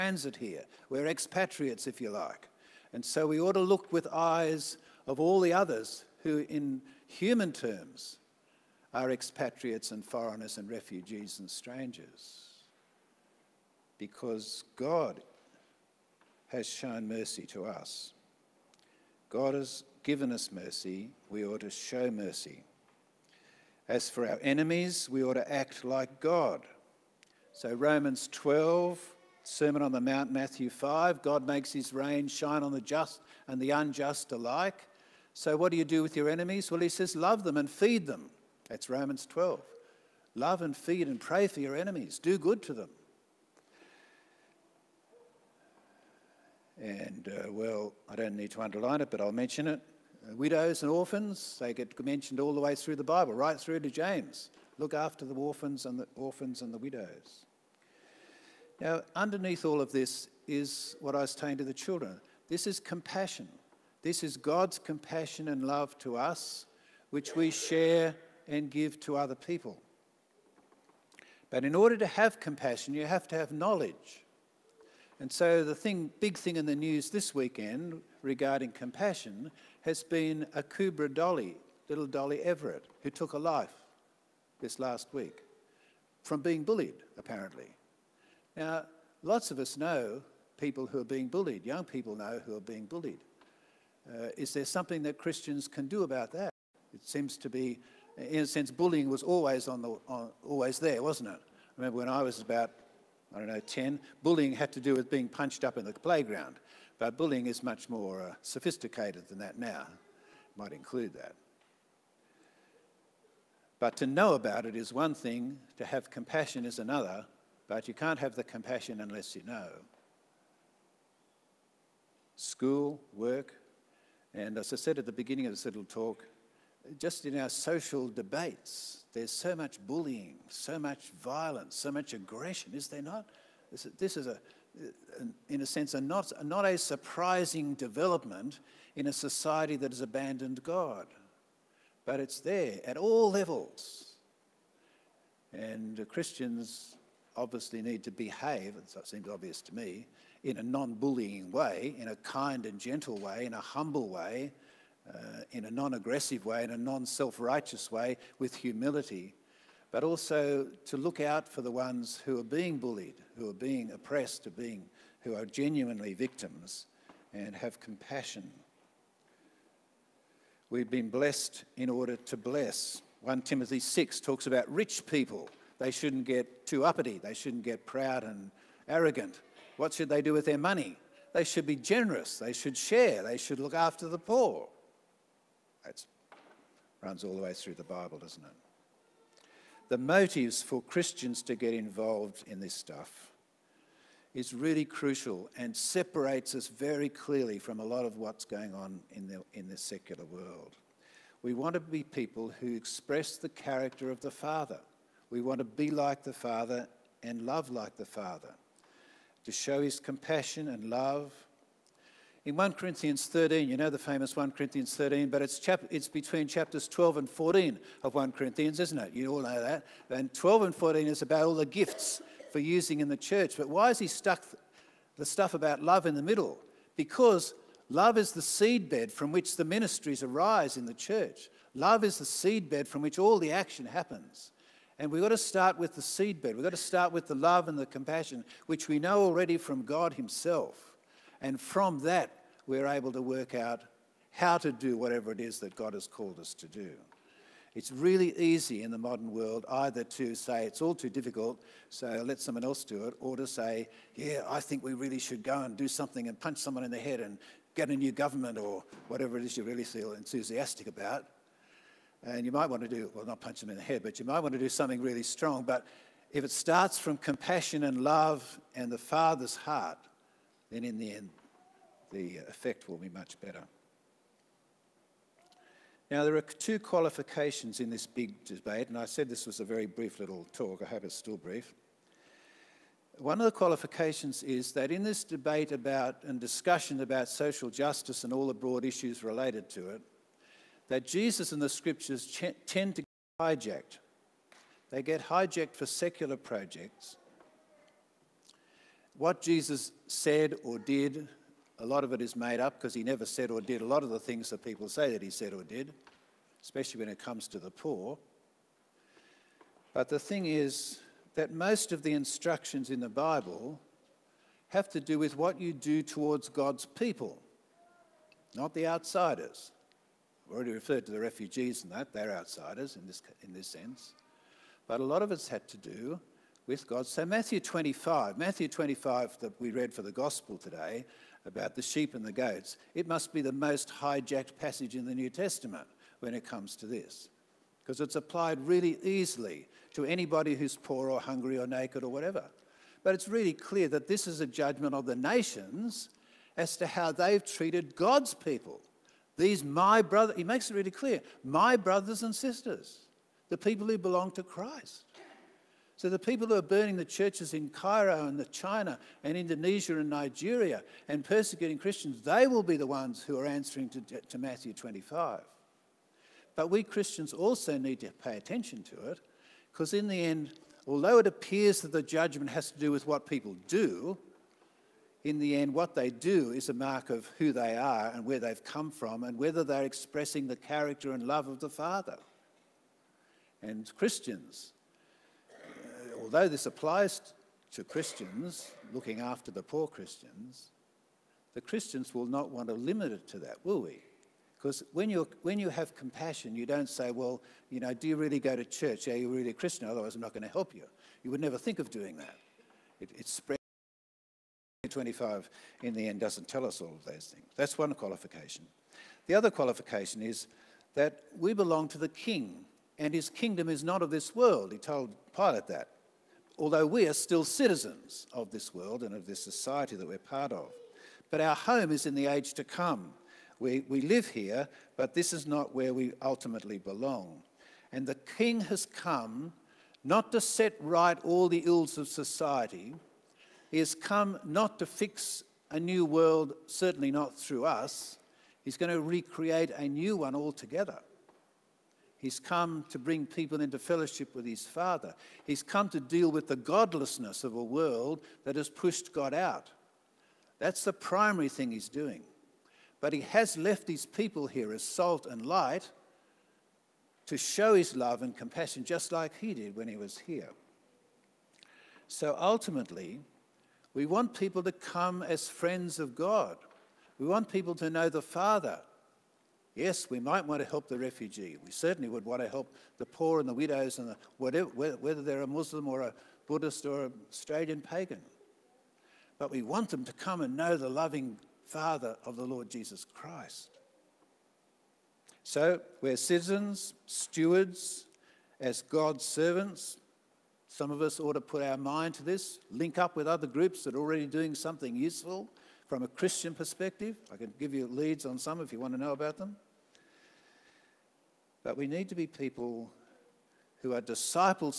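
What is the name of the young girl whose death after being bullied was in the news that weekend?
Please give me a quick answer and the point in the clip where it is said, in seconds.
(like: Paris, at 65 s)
Dolly Everett, at 82 s.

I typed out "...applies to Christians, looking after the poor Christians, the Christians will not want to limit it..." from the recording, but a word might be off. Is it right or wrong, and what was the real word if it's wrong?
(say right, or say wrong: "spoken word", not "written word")
right.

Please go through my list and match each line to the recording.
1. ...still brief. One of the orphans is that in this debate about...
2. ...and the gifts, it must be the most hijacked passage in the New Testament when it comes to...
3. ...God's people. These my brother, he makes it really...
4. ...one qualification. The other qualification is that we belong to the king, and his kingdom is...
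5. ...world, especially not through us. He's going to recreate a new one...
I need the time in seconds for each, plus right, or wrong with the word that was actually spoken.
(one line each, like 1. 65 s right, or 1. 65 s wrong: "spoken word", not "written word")
1. 281 s wrong: "qualifications", not "orphans"
2. 332 s wrong: "goats", not "gifts"
3. 347 s right
4. 407 s right
5. 436 s wrong: "certainly", not "especially".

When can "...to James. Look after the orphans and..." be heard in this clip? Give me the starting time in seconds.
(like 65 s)
53 s.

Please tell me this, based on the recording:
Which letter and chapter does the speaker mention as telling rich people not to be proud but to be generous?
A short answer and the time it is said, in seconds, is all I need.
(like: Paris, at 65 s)
1 Timothy 6, at 173 s.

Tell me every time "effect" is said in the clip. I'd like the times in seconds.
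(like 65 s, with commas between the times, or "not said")
272 s.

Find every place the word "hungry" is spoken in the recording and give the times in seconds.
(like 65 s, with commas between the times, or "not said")
341 s.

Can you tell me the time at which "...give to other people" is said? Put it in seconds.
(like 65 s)
68 s.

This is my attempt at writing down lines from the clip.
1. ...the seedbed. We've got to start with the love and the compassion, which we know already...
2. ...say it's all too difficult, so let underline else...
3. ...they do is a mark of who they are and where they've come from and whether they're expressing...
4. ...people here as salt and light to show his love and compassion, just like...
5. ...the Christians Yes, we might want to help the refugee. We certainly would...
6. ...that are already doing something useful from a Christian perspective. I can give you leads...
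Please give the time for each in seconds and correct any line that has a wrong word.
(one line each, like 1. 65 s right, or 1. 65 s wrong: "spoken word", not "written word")
1. 235 s right
2. 250 s wrong: "someone", not "underline"
3. 375 s right
4. 454 s right
5. 468 s wrong: "Father", not "Christians"
6. 493 s right.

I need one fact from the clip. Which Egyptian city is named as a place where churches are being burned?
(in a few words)
Cairo.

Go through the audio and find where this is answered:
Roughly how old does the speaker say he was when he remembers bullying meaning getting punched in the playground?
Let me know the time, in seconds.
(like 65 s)
103 s.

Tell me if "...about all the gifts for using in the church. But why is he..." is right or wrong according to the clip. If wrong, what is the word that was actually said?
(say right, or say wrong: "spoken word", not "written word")
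right.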